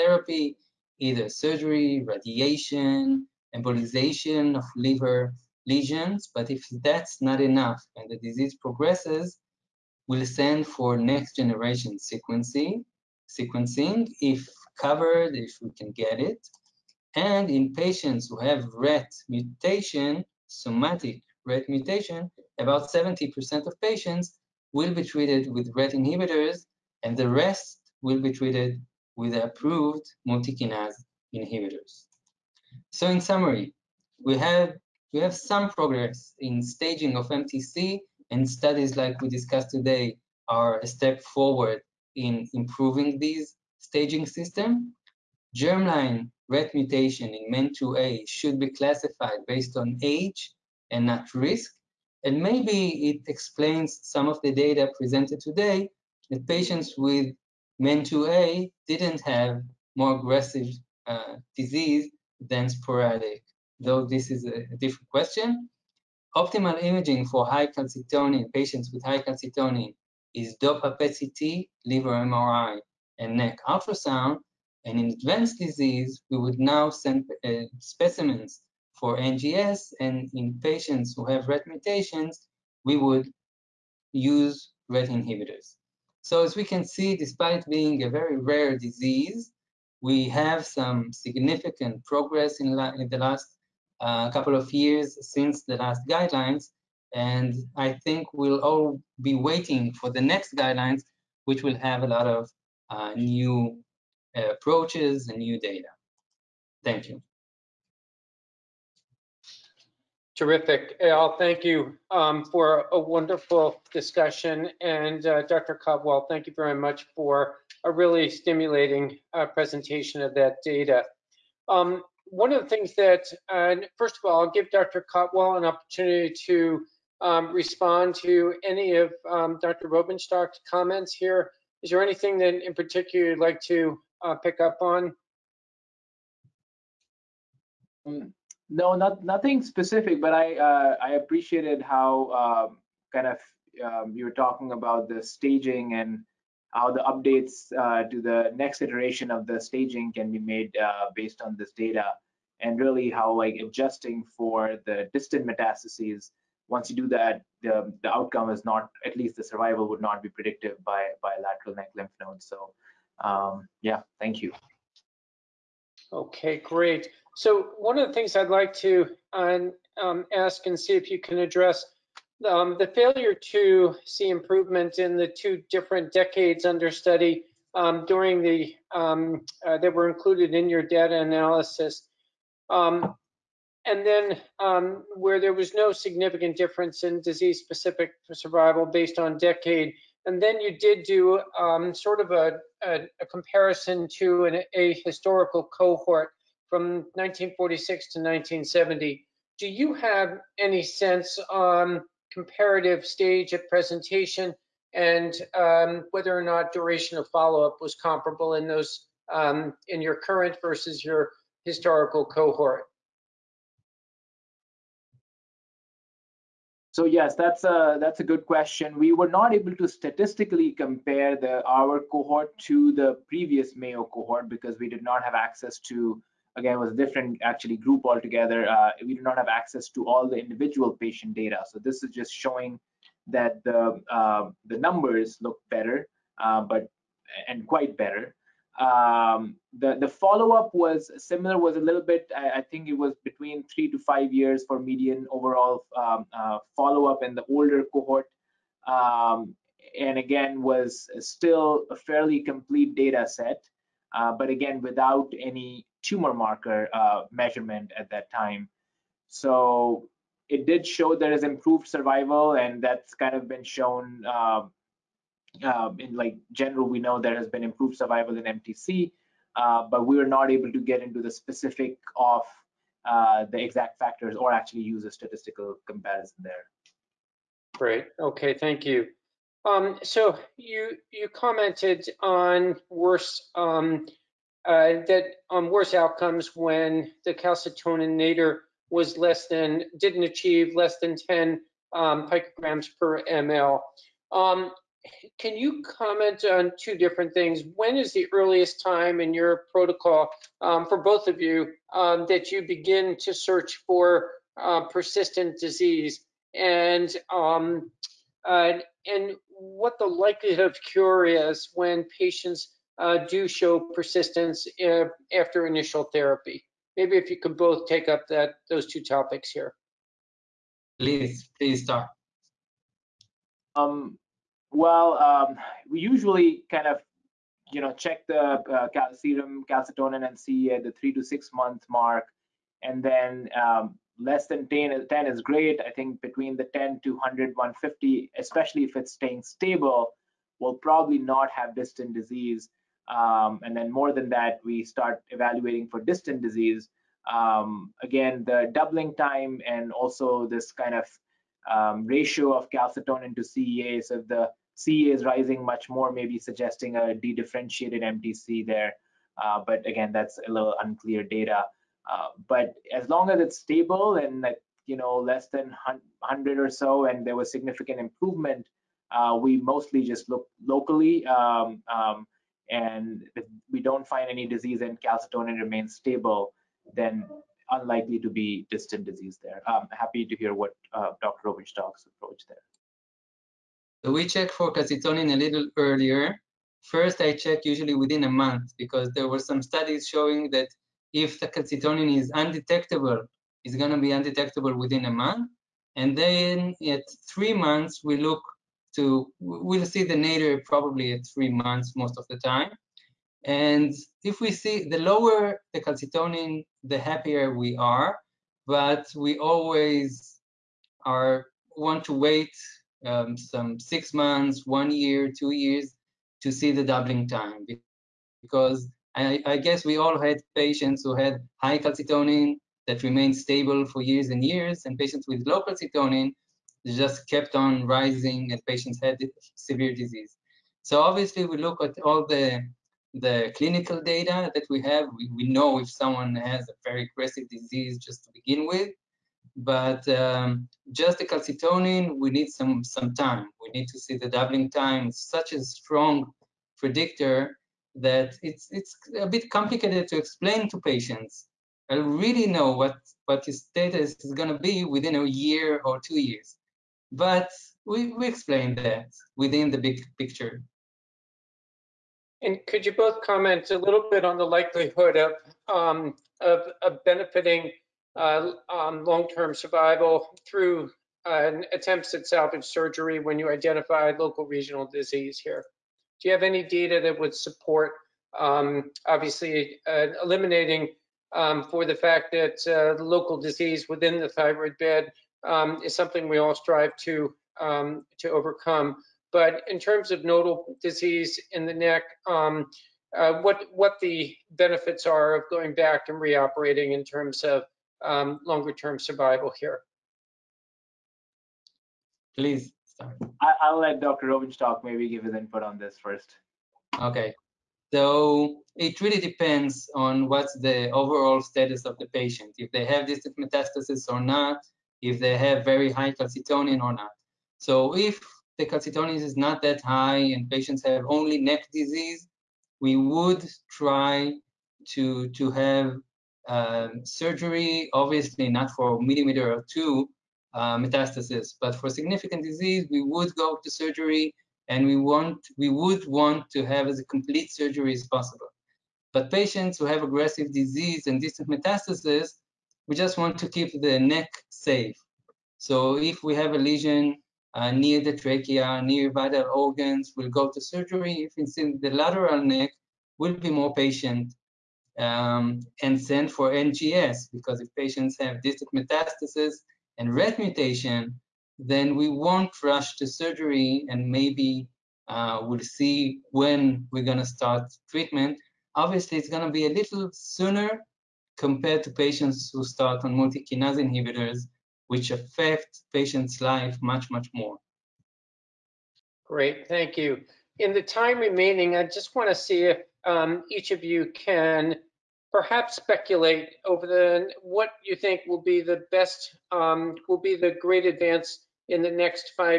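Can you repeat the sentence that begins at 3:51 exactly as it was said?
So this is just showing that the uh, the numbers look better, uh, but and quite better.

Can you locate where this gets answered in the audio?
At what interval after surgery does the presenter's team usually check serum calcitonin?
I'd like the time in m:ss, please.
5:30.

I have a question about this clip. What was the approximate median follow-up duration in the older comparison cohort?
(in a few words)
3 to 5 years.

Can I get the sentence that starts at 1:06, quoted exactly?
Optimal imaging for high calcitonin patients with high calcitonin is DOPA PET-CT, liver MRI, and neck ultrasound.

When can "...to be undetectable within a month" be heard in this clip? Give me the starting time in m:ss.
6:33.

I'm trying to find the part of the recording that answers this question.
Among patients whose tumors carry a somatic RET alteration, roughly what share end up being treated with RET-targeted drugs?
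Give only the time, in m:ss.
0:22.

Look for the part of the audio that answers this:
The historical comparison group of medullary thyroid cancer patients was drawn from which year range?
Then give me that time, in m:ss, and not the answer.
3:17.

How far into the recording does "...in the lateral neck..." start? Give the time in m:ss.
9:11.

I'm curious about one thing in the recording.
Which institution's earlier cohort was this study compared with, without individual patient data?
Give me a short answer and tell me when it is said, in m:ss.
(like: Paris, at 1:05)
Mayo, at 3:43.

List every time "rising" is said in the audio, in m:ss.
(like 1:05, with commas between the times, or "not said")
5:55, 7:07.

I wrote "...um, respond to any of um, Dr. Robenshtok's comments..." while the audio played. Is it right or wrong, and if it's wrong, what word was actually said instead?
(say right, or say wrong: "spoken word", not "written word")
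right.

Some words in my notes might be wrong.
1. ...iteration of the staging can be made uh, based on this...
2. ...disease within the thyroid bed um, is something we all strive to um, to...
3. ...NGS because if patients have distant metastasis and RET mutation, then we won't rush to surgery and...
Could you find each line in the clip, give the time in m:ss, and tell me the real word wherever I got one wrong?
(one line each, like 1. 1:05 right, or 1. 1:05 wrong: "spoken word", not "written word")
1. 2:28 right
2. 8:03 right
3. 9:16 right.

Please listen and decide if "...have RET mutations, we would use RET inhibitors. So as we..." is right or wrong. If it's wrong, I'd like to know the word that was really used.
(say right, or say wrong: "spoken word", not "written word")
right.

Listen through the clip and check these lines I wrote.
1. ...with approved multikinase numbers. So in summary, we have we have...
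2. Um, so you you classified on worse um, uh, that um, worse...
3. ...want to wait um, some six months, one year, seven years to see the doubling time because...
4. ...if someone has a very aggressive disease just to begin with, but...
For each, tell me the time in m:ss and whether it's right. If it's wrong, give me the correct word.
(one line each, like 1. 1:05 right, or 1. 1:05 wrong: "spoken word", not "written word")
1. 0:29 wrong: "inhibitors", not "numbers"
2. 4:39 wrong: "commented", not "classified"
3. 6:51 wrong: "two", not "seven"
4. 7:15 right.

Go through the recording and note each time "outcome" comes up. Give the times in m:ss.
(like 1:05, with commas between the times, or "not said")
2:38, 4:45.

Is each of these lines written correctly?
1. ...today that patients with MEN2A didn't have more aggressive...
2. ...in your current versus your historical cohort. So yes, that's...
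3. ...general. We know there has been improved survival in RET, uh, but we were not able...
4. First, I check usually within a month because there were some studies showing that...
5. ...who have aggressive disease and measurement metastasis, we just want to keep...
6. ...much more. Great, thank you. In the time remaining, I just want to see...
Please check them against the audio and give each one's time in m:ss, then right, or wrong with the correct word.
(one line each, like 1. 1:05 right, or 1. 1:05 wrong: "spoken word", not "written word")
1. 0:55 right
2. 3:29 right
3. 4:26 wrong: "MTC", not "RET"
4. 6:26 right
5. 8:59 wrong: "distant", not "measurement"
6. 9:37 right.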